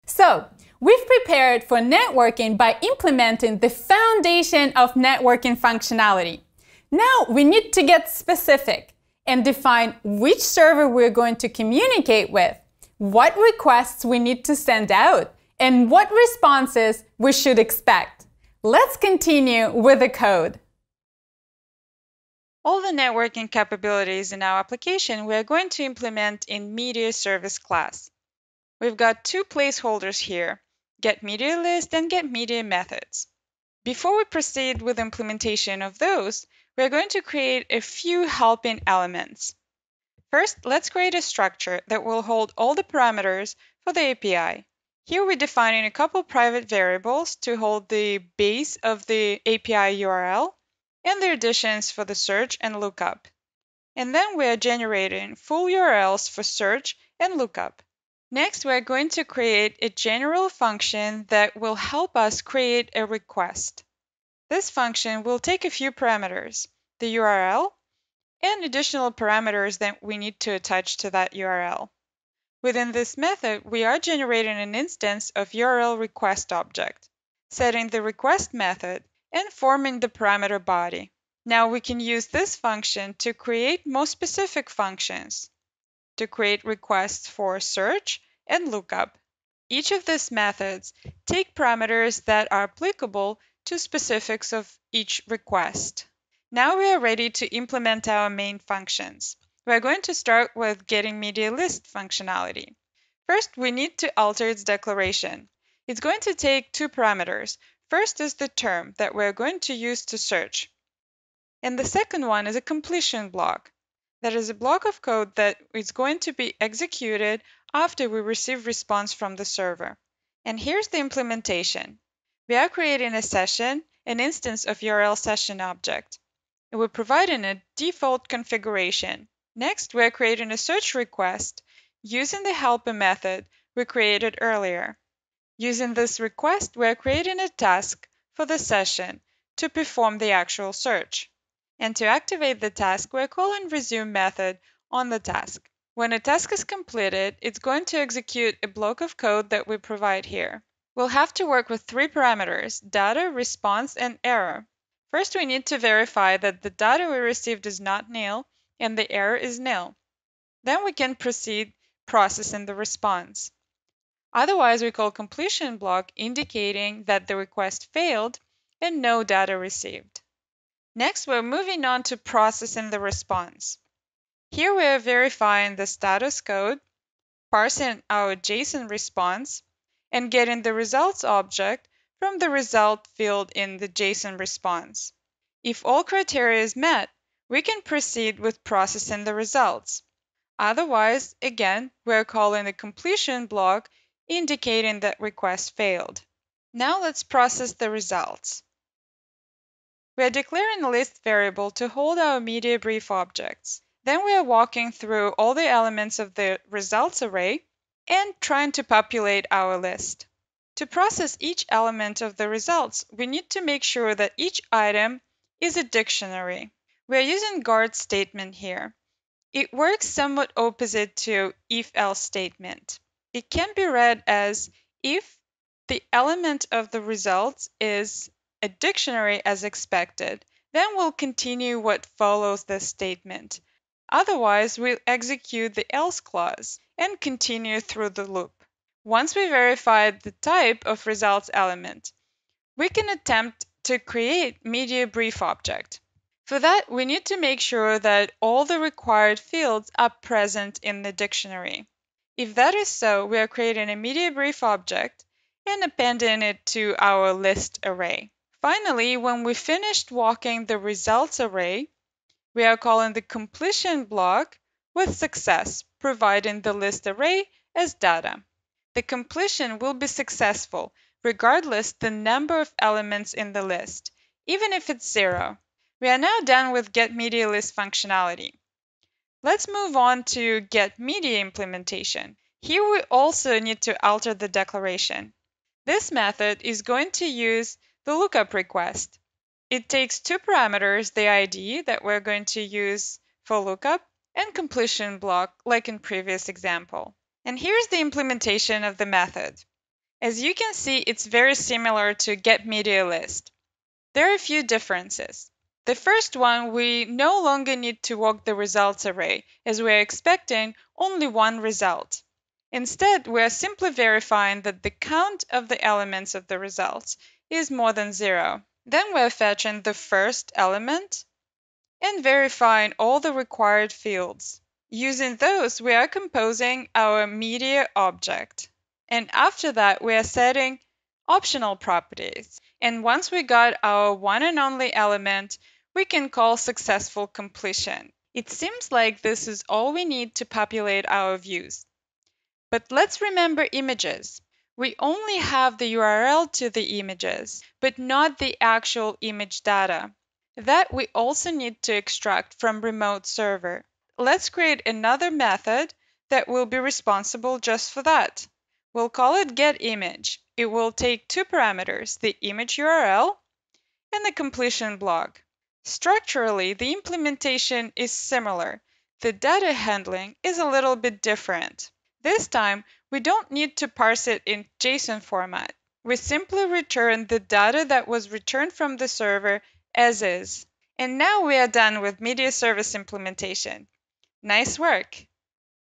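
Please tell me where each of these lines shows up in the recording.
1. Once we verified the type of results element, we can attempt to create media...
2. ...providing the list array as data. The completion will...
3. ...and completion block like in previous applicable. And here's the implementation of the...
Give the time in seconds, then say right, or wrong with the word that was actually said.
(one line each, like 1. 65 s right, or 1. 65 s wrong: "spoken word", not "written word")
1. 239 s right
2. 265 s right
3. 294 s wrong: "example", not "applicable".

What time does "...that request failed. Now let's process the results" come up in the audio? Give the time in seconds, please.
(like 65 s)
194 s.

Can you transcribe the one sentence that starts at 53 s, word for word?
And then we are generating full URLs for search and lookup.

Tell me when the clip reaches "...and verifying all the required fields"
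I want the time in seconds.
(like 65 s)
322 s.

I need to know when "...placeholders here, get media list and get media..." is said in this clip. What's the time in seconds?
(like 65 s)
29 s.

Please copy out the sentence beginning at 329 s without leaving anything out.
And after that, we are setting optional properties.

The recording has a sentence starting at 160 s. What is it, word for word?
Then we can proceed processing the response.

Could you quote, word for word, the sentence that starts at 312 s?
Instead, we are simply verifying that the count of the elements of the results is more than 0.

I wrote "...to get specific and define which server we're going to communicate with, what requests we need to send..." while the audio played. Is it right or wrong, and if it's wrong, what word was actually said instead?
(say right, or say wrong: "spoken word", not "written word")
right.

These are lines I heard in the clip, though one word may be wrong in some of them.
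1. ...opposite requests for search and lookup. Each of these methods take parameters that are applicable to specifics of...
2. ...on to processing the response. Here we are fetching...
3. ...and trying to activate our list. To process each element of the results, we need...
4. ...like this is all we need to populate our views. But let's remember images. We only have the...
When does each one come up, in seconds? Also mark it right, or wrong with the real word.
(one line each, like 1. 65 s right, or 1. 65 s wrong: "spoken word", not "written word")
1. 86 s wrong: "create", not "opposite"
2. 171 s wrong: "verifying", not "fetching"
3. 208 s wrong: "populate", not "activate"
4. 338 s right.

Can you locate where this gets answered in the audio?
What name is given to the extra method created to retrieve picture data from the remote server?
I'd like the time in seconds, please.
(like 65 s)
359 s.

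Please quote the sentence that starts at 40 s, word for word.
First, let's create a structure that will hold all the parameters for the API.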